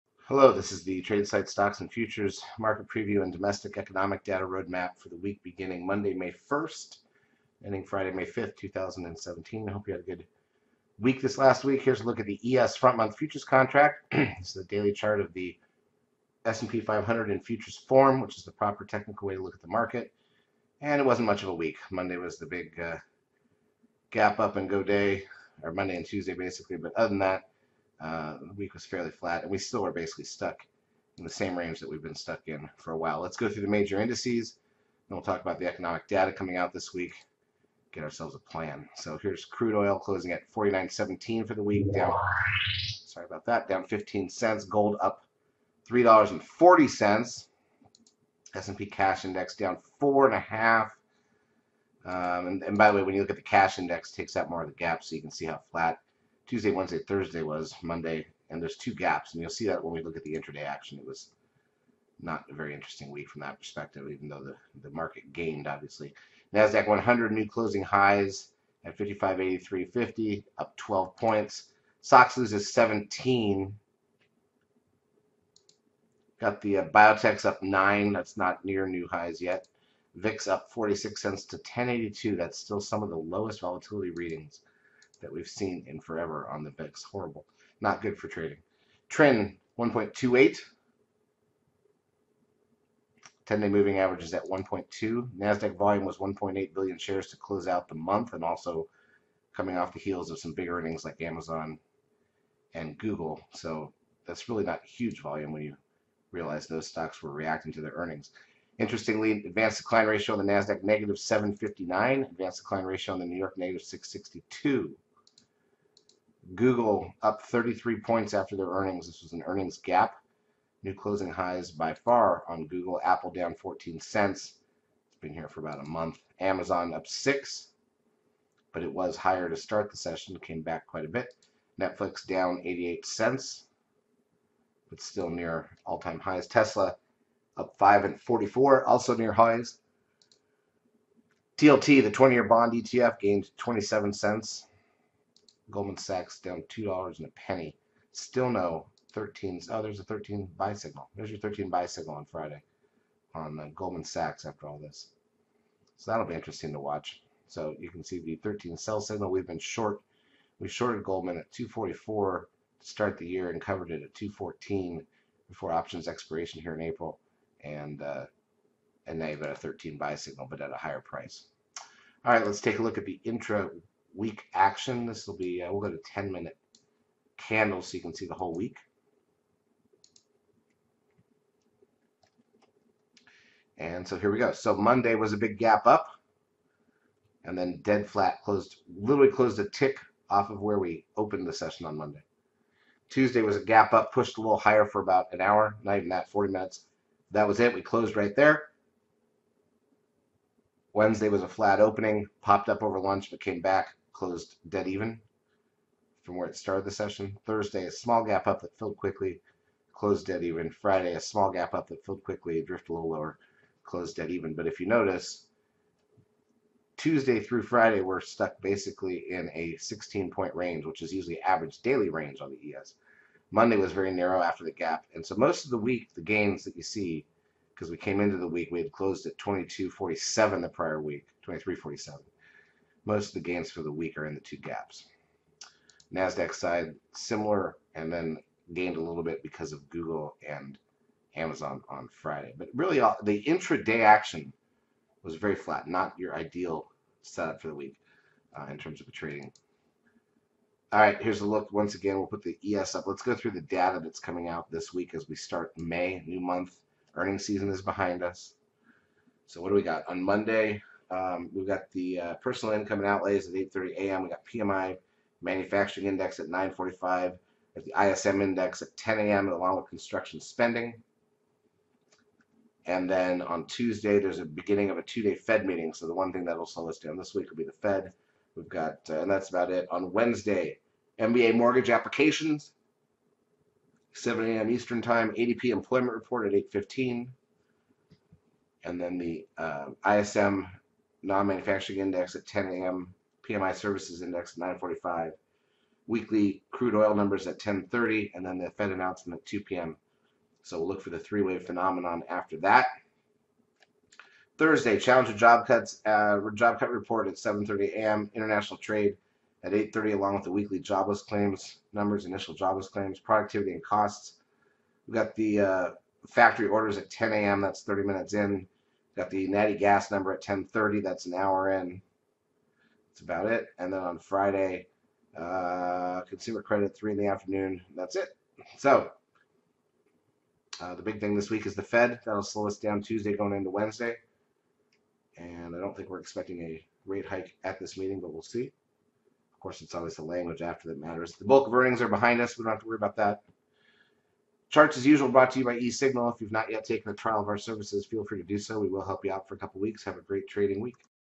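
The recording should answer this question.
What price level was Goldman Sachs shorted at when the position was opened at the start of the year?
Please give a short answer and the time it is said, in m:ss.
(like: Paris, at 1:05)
244, at 2:41.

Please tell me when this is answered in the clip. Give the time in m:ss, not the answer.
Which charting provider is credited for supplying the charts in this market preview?
5:45.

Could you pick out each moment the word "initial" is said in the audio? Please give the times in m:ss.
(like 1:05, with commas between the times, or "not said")
5:12.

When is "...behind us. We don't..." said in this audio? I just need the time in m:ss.
5:42.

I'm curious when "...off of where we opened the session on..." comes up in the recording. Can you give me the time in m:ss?
3:10.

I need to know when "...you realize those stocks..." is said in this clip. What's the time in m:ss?
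1:45.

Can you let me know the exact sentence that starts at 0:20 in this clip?
And it wasn't much of a week.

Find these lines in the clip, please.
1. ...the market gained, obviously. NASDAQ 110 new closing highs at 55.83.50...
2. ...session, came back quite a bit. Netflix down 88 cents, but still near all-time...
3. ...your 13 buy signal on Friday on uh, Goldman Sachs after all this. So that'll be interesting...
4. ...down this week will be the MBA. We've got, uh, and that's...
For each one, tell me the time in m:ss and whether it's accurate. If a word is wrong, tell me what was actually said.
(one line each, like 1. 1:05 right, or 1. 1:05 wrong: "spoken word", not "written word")
1. 1:04 wrong: "100", not "110"
2. 2:09 right
3. 2:31 right
4. 4:36 wrong: "Fed", not "MBA".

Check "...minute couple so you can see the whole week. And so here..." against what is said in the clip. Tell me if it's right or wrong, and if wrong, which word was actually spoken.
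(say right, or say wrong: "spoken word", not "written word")
wrong: "candle", not "couple".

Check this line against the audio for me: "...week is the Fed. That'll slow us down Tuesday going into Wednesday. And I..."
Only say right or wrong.
right.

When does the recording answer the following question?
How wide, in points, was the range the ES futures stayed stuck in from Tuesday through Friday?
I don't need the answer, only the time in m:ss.
3:39.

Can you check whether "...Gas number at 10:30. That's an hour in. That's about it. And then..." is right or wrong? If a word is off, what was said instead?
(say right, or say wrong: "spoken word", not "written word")
right.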